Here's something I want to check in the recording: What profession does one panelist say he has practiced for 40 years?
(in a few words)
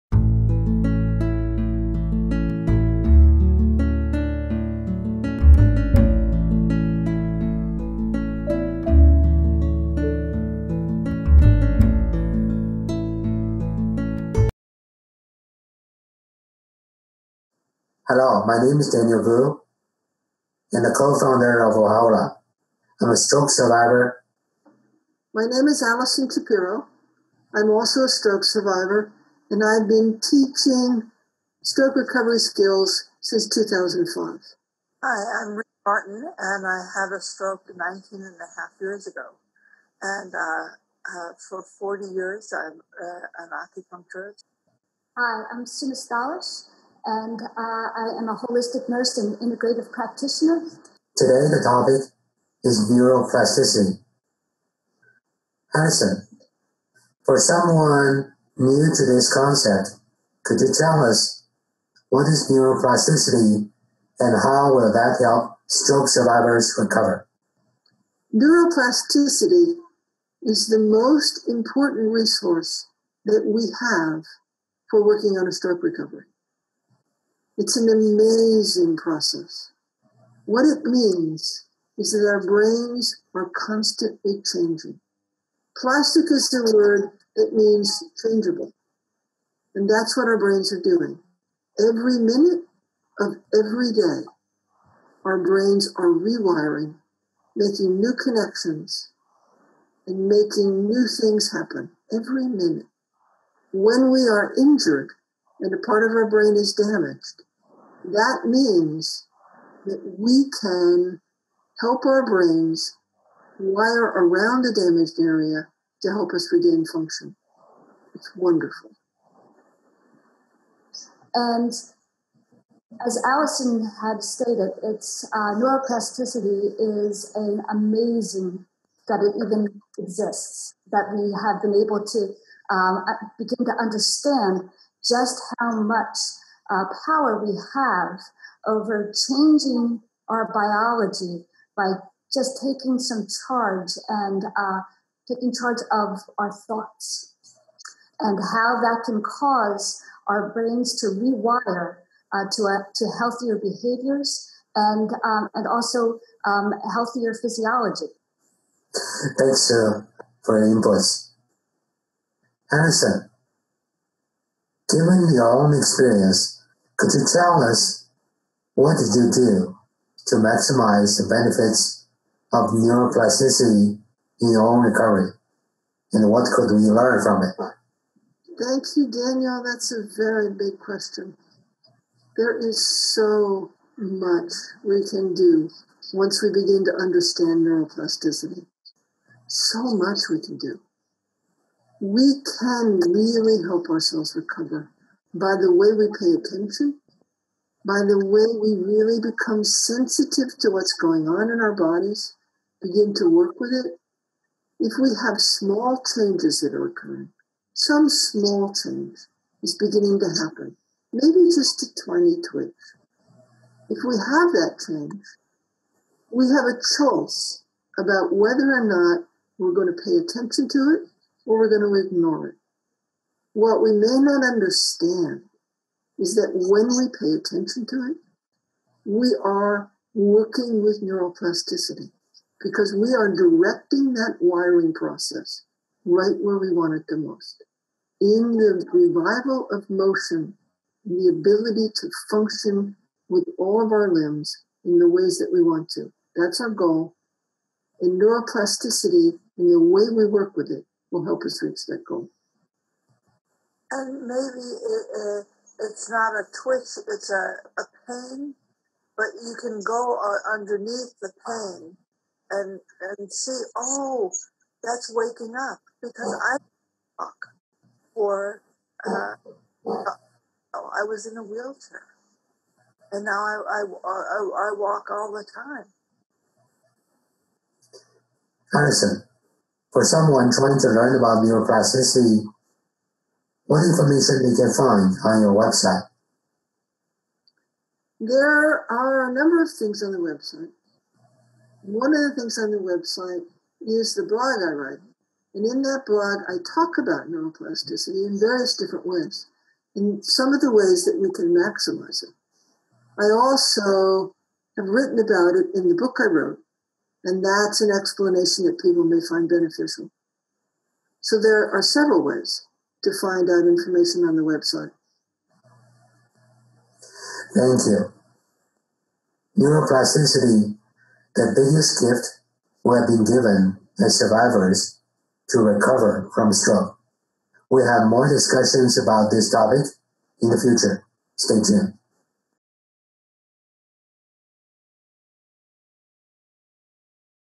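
Acupuncturist.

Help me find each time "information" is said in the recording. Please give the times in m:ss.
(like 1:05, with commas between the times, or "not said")
4:43, 5:13.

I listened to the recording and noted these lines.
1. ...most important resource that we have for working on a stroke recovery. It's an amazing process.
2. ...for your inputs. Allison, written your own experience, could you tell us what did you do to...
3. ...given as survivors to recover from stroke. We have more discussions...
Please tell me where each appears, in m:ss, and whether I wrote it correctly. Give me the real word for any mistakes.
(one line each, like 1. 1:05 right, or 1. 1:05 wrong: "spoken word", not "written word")
1. 1:10 right
2. 2:40 wrong: "given", not "written"
3. 5:23 right.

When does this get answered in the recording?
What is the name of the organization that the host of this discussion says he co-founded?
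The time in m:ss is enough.
0:21.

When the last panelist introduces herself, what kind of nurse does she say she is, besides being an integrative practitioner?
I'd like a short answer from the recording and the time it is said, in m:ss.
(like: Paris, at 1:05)
Holistic nurse, at 0:48.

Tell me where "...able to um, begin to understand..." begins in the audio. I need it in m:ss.
2:11.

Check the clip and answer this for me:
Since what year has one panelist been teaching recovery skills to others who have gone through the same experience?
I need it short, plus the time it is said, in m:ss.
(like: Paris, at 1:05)
2005, at 0:33.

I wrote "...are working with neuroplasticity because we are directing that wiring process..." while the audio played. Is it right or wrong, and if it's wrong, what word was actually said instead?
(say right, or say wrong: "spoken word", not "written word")
right.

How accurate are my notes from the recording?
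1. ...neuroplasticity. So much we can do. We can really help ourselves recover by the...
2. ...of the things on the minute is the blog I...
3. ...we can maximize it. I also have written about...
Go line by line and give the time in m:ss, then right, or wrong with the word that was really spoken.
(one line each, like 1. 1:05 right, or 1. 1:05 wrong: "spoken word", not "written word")
1. 3:07 right
2. 4:52 wrong: "website", not "minute"
3. 5:01 right.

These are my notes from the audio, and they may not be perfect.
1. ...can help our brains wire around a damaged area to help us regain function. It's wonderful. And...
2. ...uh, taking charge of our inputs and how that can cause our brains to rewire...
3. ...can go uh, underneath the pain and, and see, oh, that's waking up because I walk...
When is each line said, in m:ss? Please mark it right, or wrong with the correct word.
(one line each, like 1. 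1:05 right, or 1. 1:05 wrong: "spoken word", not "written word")
1. 1:50 right
2. 2:24 wrong: "thoughts", not "inputs"
3. 4:19 right.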